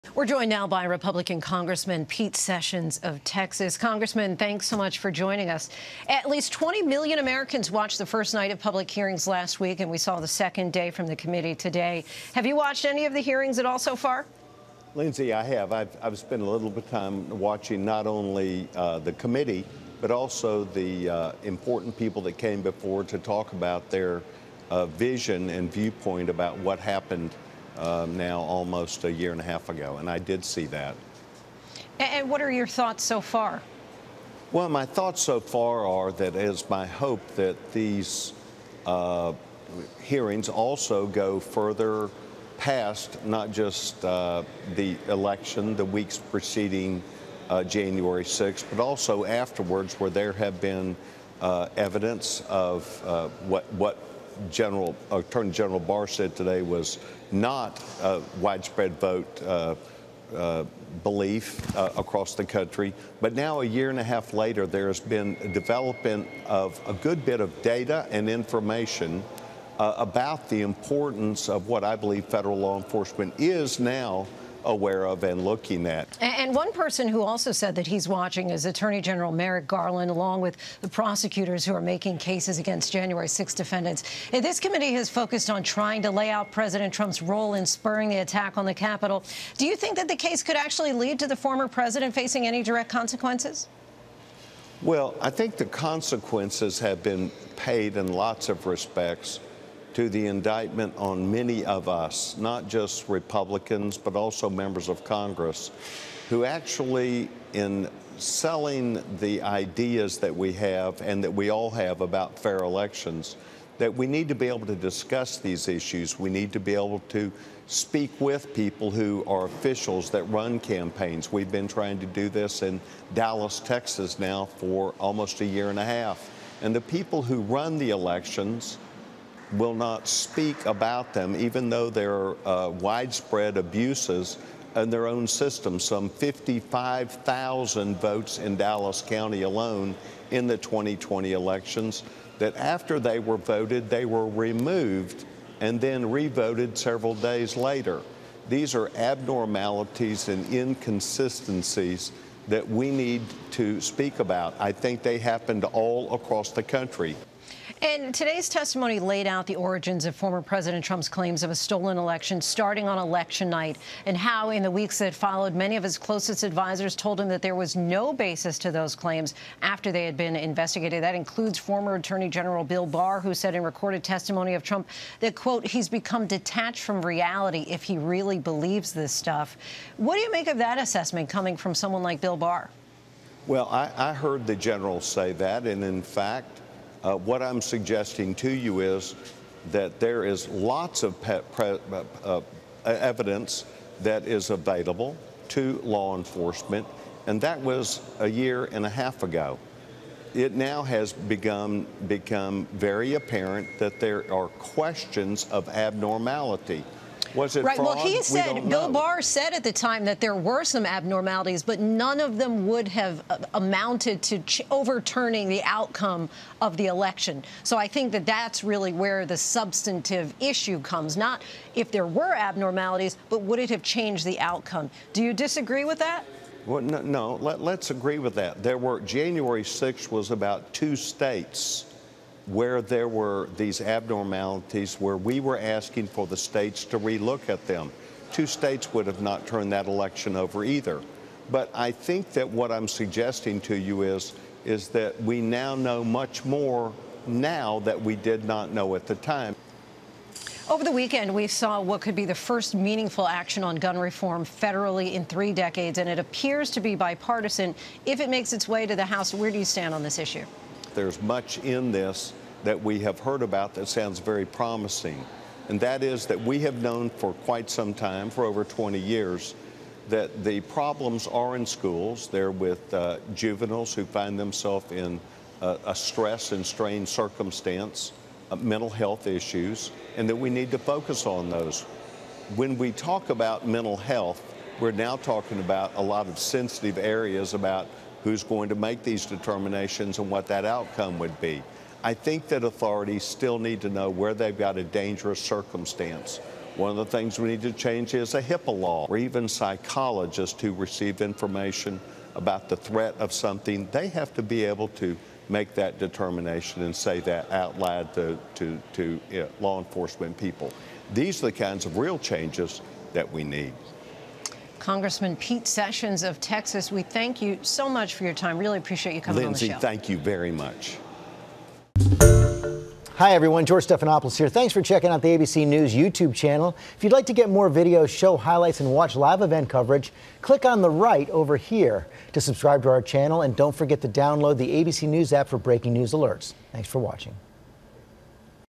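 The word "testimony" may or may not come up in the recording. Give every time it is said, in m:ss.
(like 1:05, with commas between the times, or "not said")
2:38, 2:54.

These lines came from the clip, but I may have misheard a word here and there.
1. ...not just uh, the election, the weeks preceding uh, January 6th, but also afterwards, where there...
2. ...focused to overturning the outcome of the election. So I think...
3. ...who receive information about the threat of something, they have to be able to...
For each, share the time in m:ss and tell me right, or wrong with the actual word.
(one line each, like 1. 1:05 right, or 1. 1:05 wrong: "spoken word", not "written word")
1. 0:43 right
2. 3:33 wrong: "amounted", not "focused"
3. 5:00 right.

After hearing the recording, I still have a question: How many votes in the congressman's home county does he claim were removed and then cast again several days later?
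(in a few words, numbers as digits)
55,000.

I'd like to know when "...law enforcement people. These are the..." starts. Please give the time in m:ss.
5:09.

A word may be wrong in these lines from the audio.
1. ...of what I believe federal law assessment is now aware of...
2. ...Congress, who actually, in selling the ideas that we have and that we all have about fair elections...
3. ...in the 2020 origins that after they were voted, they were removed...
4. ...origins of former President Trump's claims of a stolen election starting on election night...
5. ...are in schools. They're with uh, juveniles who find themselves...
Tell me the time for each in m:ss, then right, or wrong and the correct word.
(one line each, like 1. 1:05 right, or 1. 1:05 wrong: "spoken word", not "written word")
1. 1:11 wrong: "enforcement", not "assessment"
2. 1:45 right
3. 2:20 wrong: "elections", not "origins"
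4. 2:39 right
5. 4:31 right.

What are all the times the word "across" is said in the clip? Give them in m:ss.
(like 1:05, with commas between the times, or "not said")
1:01, 2:36.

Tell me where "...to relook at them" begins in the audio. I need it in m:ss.
3:56.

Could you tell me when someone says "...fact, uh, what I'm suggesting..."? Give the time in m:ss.
3:06.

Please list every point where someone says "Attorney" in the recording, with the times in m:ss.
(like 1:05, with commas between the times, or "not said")
0:55, 1:18, 2:51.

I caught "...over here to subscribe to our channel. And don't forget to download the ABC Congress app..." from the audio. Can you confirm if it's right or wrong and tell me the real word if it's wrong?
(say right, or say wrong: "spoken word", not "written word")
wrong: "News", not "Congress".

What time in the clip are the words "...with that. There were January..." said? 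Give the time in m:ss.
3:48.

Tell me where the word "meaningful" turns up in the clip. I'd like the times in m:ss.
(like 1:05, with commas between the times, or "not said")
4:12.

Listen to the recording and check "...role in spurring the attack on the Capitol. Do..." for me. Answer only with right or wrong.
right.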